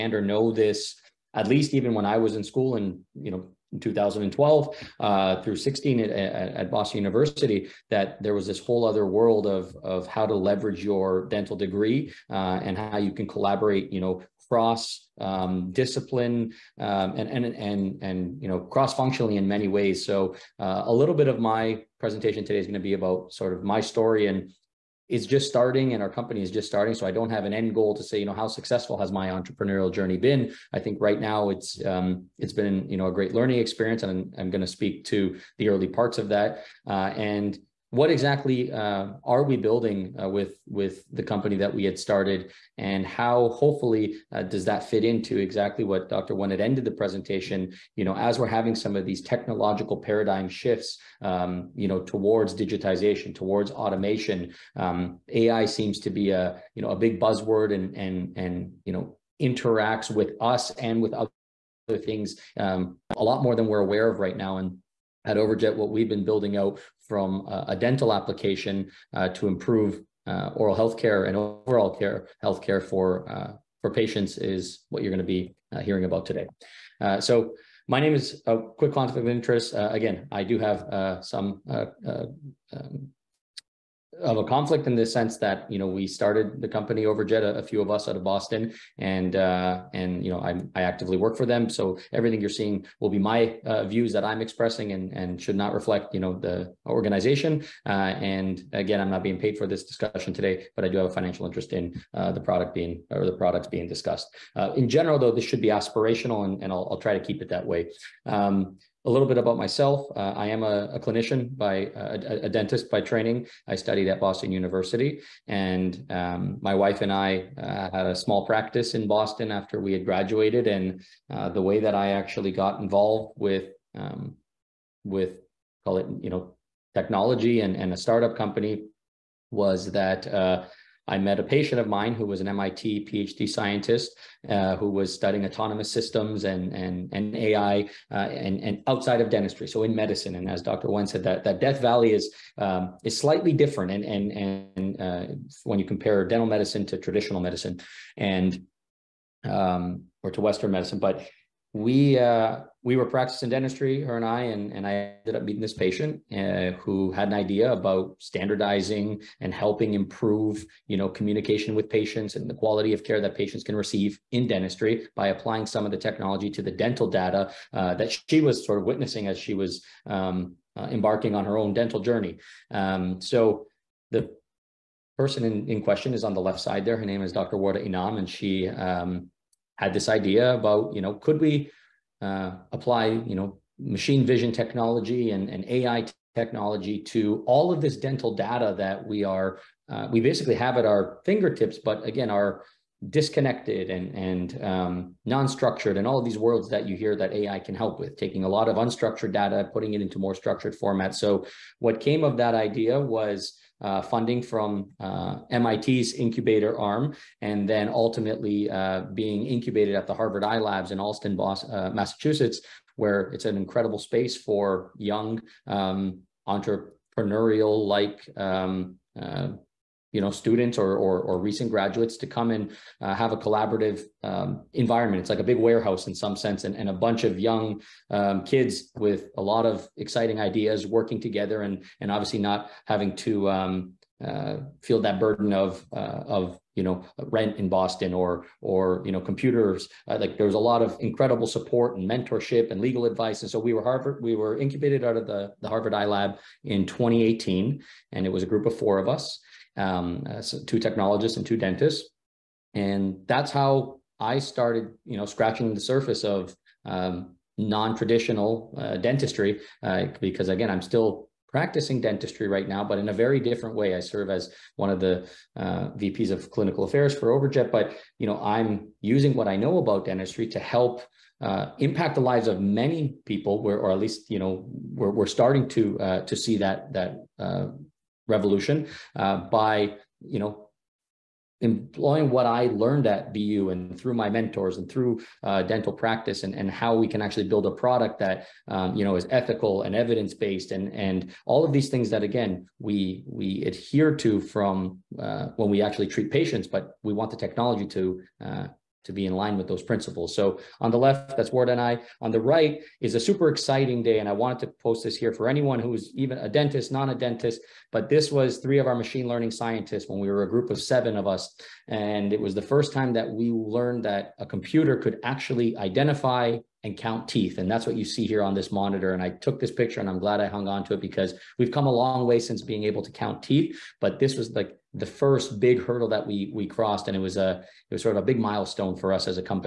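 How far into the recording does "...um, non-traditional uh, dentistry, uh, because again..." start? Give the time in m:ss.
4:16.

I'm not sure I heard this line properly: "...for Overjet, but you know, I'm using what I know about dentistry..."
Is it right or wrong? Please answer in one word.
right.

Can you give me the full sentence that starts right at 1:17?
so my name is a quick conflict of interest.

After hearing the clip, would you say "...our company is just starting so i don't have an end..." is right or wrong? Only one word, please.
right.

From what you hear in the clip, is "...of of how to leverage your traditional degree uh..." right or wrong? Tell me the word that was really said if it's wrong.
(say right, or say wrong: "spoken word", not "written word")
wrong: "dental", not "traditional".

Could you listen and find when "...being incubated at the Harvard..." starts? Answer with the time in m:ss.
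3:29.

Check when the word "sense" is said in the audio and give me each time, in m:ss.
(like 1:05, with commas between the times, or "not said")
1:25, 3:46.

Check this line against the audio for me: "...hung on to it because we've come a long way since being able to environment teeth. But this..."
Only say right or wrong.
wrong.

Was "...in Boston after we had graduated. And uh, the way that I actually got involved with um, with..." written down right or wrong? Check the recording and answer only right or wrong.
right.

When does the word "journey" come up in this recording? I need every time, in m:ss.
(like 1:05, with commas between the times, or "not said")
0:29, 2:51.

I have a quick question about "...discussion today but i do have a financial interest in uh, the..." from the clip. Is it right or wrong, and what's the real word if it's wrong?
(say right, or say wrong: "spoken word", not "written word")
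right.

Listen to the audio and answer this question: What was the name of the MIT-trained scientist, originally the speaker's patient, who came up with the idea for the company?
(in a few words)
Dr. Warda Inam.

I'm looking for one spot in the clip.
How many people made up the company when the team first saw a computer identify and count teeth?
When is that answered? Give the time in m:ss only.
5:10.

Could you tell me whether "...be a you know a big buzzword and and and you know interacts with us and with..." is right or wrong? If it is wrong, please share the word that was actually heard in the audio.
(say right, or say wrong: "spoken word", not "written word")
right.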